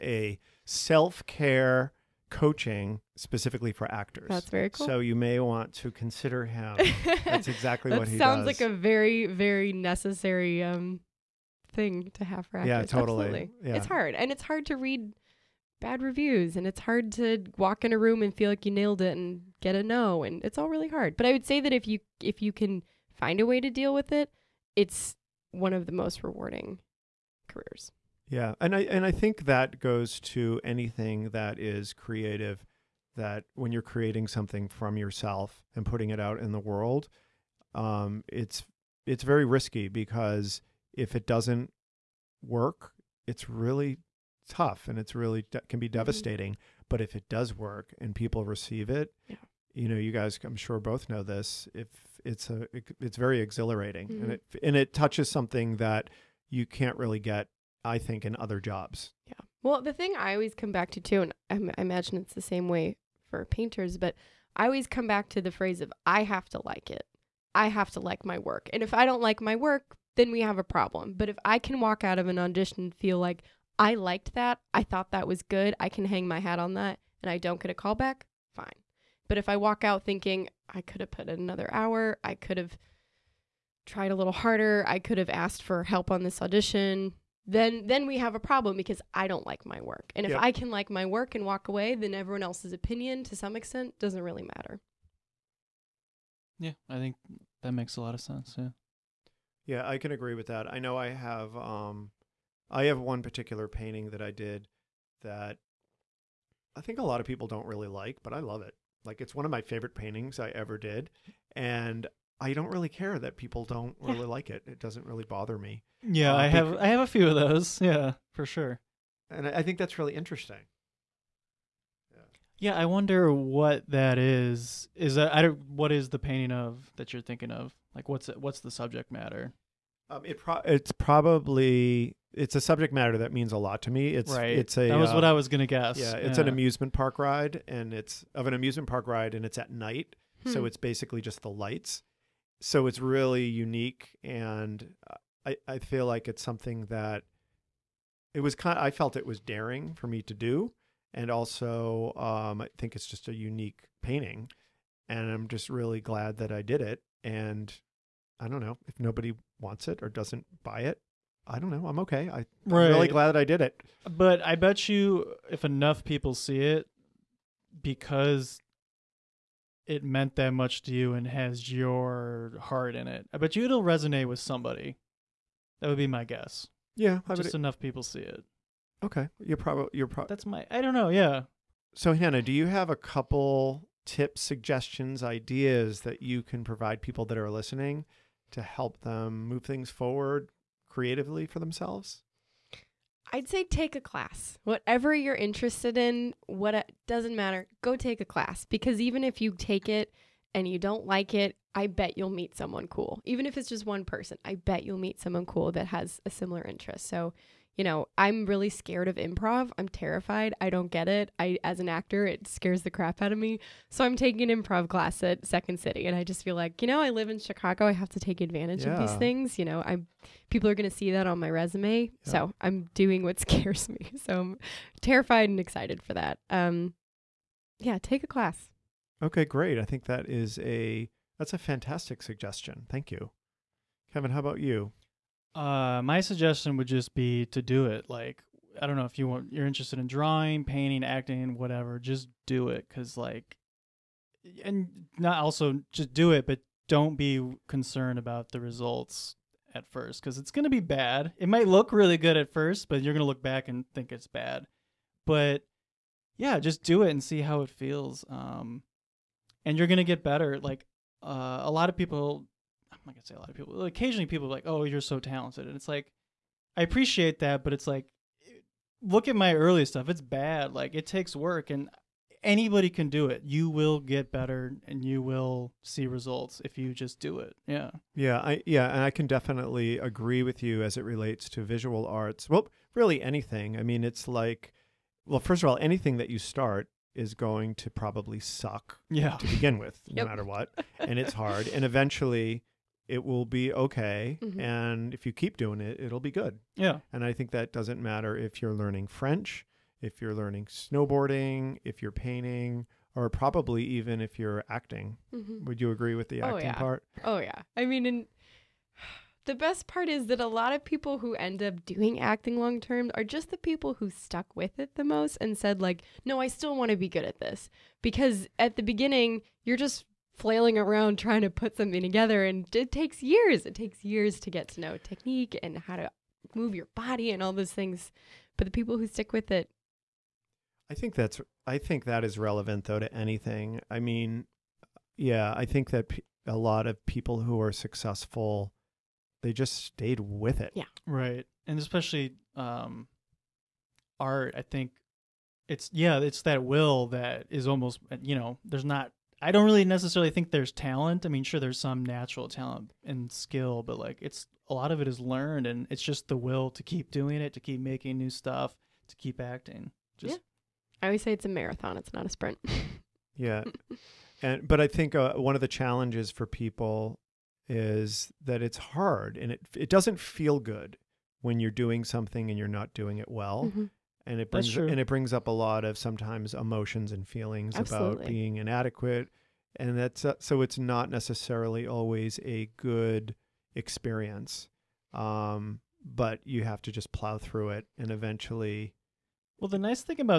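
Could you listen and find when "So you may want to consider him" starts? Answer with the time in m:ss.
0:04.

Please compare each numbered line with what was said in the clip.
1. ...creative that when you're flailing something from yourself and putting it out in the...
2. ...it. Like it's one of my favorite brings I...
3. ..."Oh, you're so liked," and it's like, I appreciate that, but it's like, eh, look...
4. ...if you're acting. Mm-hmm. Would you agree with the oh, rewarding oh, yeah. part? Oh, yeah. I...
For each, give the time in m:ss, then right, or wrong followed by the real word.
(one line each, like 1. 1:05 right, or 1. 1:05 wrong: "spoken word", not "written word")
1. 0:31 wrong: "creating", not "flailing"
2. 1:48 wrong: "paintings", not "brings"
3. 4:24 wrong: "talented", not "liked"
4. 5:04 wrong: "acting", not "rewarding".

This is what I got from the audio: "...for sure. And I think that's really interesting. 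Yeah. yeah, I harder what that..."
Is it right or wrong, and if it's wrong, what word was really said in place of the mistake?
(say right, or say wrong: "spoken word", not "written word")
wrong: "wonder", not "harder".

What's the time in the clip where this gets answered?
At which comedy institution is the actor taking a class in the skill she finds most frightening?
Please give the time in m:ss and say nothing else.
3:35.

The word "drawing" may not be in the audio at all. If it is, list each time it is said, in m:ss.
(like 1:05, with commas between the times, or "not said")
4:00.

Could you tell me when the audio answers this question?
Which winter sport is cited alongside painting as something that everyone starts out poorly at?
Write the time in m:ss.
5:00.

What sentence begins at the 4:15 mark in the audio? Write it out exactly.
But yeah, just do it and see how it feels.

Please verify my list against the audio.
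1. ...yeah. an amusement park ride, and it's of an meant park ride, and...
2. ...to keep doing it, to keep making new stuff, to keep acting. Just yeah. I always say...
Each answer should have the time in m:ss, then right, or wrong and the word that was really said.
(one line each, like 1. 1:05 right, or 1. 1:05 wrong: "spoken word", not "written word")
1. 2:16 wrong: "amusement", not "meant"
2. 5:56 right.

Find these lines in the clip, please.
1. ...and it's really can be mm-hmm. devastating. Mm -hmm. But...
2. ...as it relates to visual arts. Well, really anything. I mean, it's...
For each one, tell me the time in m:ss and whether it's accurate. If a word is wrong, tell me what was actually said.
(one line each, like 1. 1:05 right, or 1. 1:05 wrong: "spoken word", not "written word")
1. 0:44 right
2. 4:40 right.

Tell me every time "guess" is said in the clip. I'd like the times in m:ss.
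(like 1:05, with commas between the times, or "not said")
2:15, 2:56.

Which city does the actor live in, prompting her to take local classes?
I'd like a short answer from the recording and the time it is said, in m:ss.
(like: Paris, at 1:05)
Chicago, at 3:37.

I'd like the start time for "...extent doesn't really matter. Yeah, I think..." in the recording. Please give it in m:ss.
1:33.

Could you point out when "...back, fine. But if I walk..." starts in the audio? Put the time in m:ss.
1:17.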